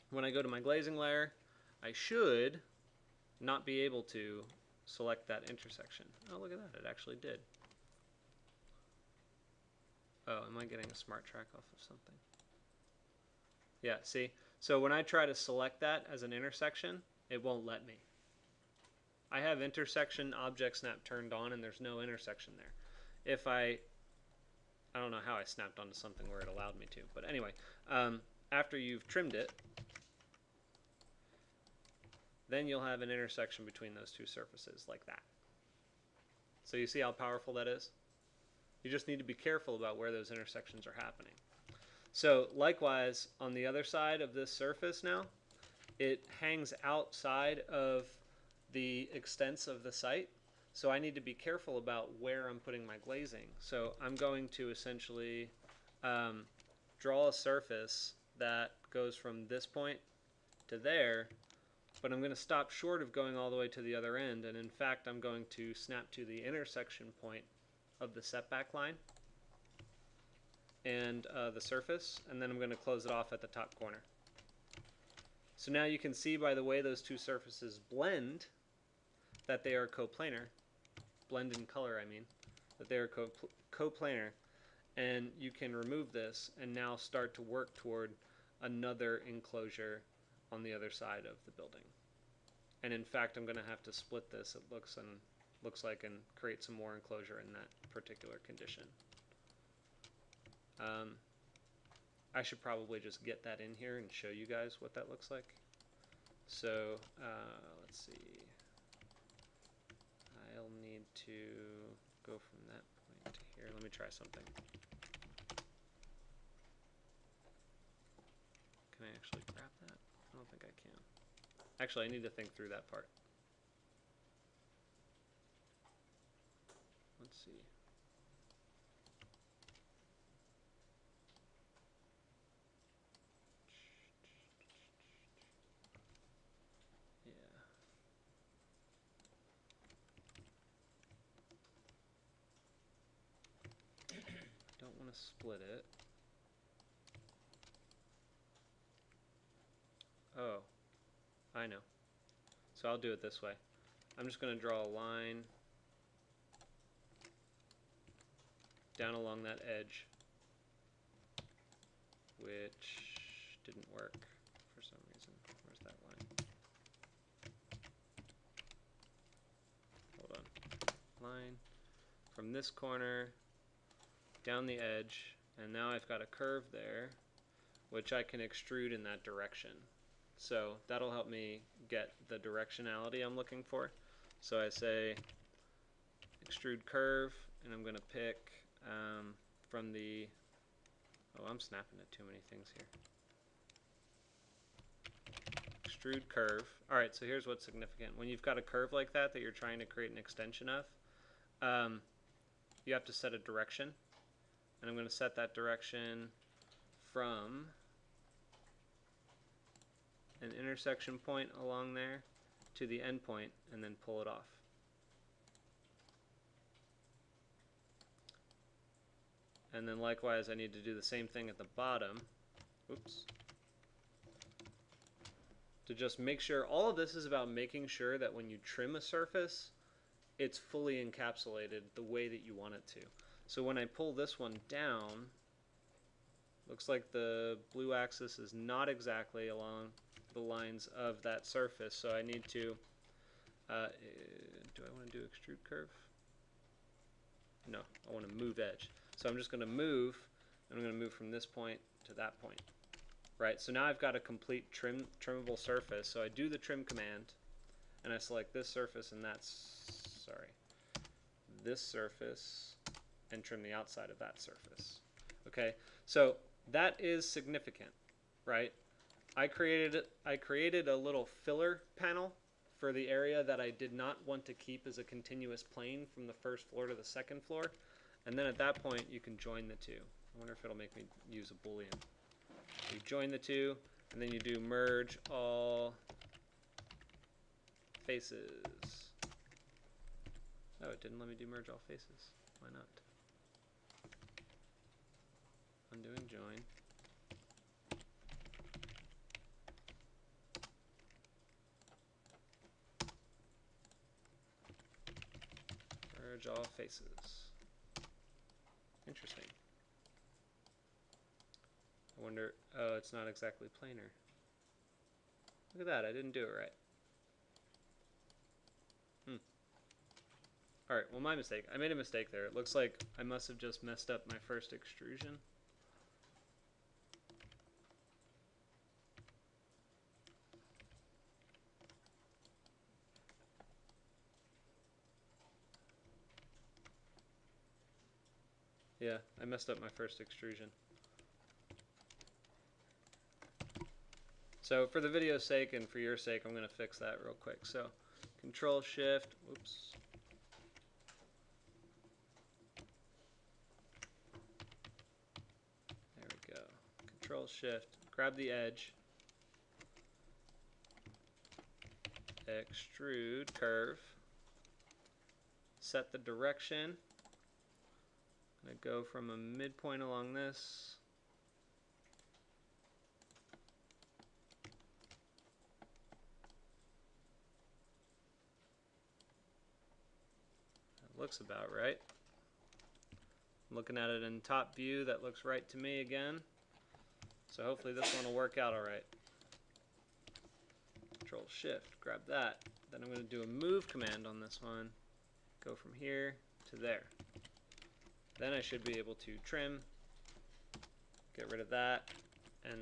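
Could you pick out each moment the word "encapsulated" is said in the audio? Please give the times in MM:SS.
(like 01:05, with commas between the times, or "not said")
03:51.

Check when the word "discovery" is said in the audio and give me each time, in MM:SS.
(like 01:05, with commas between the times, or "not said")
not said.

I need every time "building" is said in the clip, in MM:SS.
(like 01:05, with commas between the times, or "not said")
01:31.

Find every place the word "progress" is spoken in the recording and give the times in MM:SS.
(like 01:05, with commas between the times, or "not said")
not said.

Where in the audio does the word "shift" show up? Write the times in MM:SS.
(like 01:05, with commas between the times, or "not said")
05:48, 05:57, 06:31.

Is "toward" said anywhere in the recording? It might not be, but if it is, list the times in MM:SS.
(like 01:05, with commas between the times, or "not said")
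01:27.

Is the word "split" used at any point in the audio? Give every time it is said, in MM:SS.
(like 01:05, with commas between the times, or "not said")
01:33, 02:25.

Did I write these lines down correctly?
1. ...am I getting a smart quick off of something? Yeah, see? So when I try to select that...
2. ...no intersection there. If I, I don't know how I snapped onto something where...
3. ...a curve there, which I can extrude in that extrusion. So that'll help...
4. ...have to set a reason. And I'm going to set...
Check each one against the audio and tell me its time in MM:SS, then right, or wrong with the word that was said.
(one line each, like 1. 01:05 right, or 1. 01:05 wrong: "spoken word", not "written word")
1. 00:10 wrong: "track", not "quick"
2. 00:21 right
3. 02:56 wrong: "direction", not "extrusion"
4. 03:22 wrong: "direction", not "reason".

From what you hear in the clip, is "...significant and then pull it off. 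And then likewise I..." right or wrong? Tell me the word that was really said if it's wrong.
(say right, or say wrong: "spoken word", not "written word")
wrong: "endpoint", not "significant".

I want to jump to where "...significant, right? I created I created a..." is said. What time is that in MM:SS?
04:27.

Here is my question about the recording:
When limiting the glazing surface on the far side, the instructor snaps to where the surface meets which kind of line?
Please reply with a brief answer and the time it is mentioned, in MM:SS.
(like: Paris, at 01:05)
setback line, at 01:08.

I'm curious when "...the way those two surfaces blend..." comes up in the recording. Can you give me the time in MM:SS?
01:16.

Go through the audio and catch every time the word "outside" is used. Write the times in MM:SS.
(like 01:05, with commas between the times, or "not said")
00:46, 04:23.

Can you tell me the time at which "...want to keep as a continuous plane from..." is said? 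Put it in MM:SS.
04:34.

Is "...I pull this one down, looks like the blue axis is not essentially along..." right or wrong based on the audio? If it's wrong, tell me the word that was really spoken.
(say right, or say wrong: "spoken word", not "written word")
wrong: "exactly", not "essentially".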